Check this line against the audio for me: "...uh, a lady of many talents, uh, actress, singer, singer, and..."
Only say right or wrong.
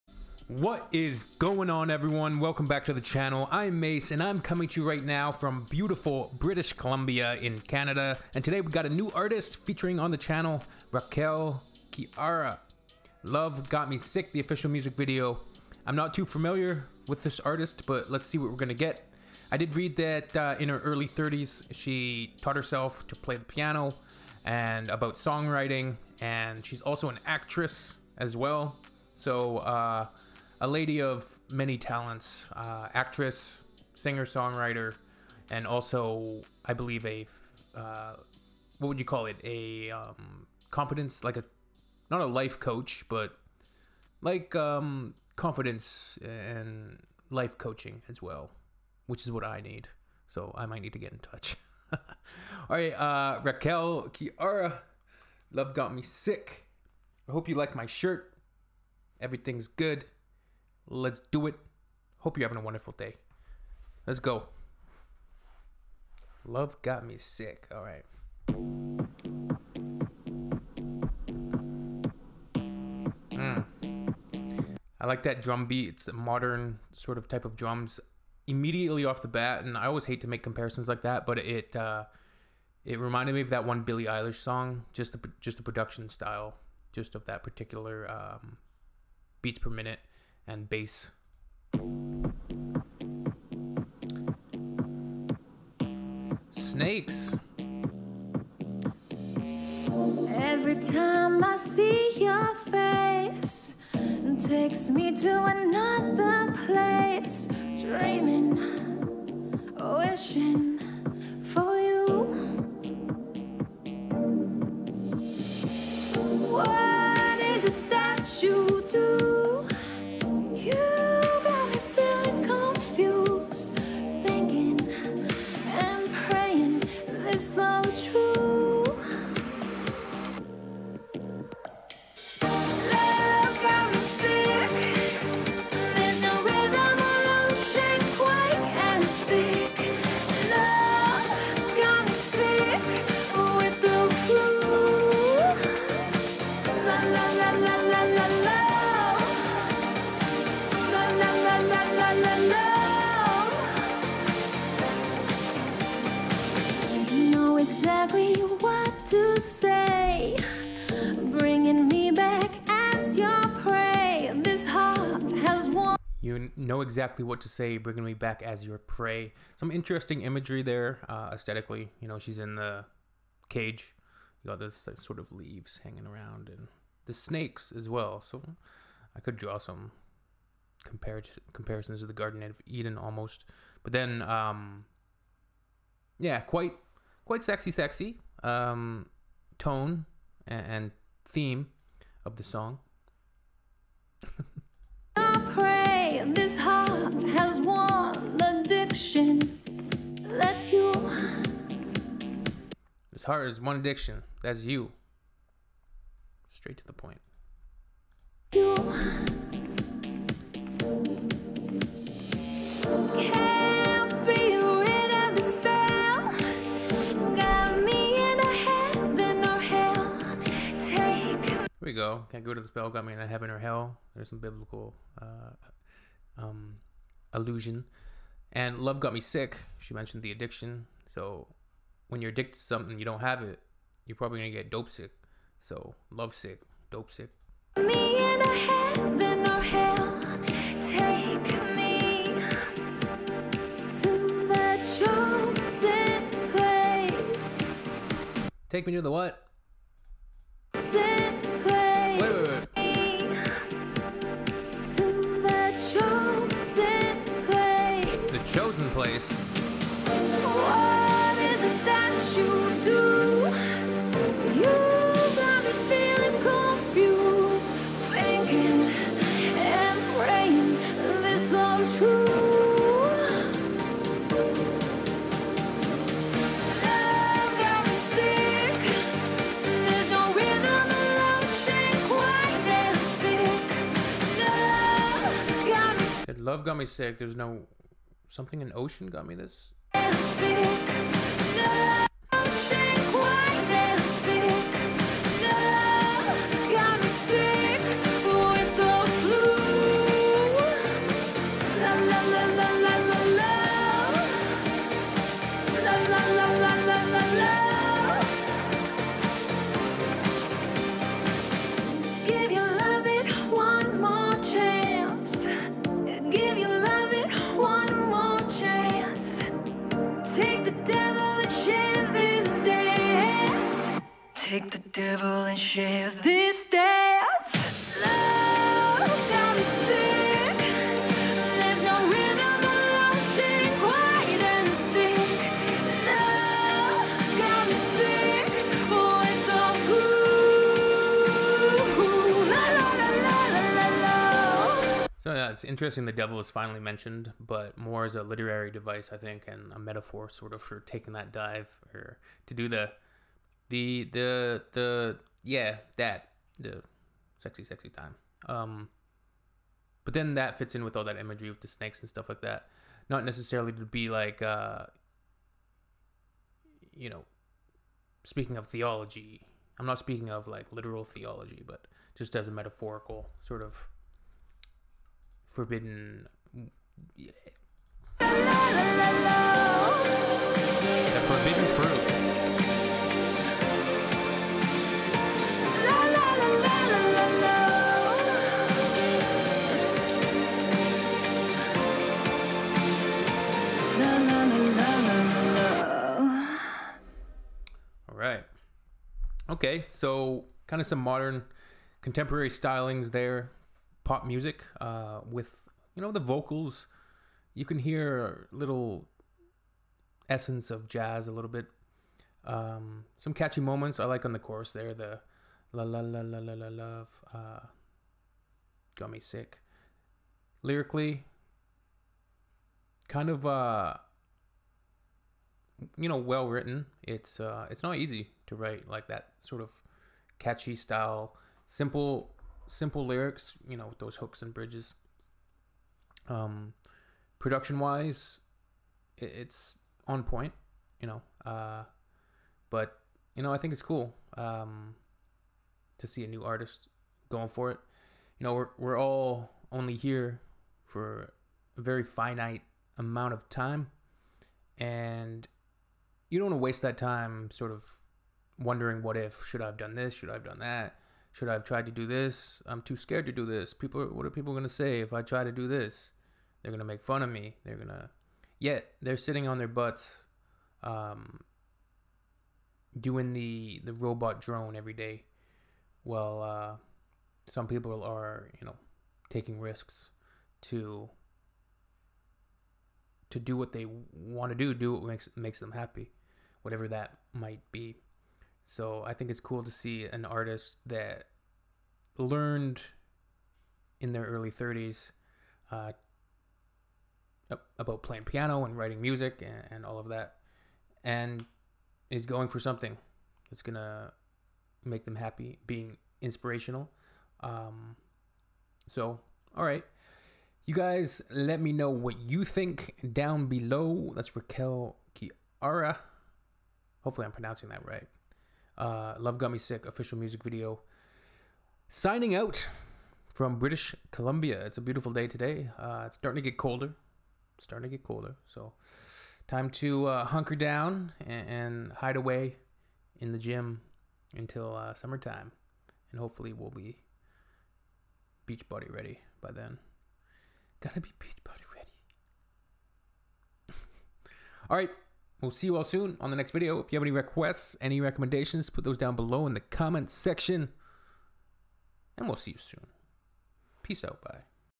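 wrong.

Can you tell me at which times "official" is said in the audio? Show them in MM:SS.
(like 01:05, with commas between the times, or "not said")
00:14, 08:39.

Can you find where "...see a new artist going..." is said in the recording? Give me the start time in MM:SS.
07:26.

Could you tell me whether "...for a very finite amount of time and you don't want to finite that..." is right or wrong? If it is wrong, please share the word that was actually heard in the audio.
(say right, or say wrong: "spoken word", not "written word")
wrong: "waste", not "finite".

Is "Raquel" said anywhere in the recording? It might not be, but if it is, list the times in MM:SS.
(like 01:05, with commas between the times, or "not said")
00:10, 00:53, 08:34.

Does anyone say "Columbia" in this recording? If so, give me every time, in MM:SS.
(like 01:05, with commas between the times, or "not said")
00:06, 08:44.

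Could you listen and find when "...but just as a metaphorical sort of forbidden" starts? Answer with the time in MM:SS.
06:11.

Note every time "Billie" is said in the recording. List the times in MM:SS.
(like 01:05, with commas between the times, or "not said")
01:23.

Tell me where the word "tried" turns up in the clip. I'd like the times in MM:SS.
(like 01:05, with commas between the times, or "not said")
07:41.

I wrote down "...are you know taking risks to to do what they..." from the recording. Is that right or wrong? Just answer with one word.
right.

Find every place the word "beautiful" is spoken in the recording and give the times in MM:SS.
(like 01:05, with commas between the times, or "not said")
00:05, 08:44.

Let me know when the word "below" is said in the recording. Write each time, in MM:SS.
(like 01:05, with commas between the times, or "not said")
08:33, 09:09.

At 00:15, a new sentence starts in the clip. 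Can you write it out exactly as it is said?
I'm not too familiar with this artist, but let's see what we're gonna get.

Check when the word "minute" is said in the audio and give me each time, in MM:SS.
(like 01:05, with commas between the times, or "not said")
01:29.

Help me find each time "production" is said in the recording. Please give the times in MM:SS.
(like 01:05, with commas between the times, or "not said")
01:25, 07:17.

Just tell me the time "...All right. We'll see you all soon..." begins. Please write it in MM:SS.
09:04.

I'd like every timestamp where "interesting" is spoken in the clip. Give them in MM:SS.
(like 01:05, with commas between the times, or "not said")
02:49, 05:45.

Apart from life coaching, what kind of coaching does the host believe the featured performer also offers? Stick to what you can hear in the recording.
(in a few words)
Confidence.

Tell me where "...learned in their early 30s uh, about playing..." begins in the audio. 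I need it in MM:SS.
08:12.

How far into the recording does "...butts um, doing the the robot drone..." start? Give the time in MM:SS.
07:49.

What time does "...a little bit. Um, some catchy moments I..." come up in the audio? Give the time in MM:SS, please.
06:51.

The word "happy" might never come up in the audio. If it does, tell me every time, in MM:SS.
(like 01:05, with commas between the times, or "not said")
08:05, 08:25.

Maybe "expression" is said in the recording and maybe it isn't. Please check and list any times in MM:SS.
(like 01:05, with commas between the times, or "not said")
not said.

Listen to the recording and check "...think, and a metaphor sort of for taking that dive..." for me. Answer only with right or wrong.
right.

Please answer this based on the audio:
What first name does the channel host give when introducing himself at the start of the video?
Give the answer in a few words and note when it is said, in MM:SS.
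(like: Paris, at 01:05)
Mace, at 00:03.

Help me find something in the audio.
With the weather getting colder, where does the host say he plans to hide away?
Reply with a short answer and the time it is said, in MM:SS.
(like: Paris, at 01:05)
The gym, at 08:53.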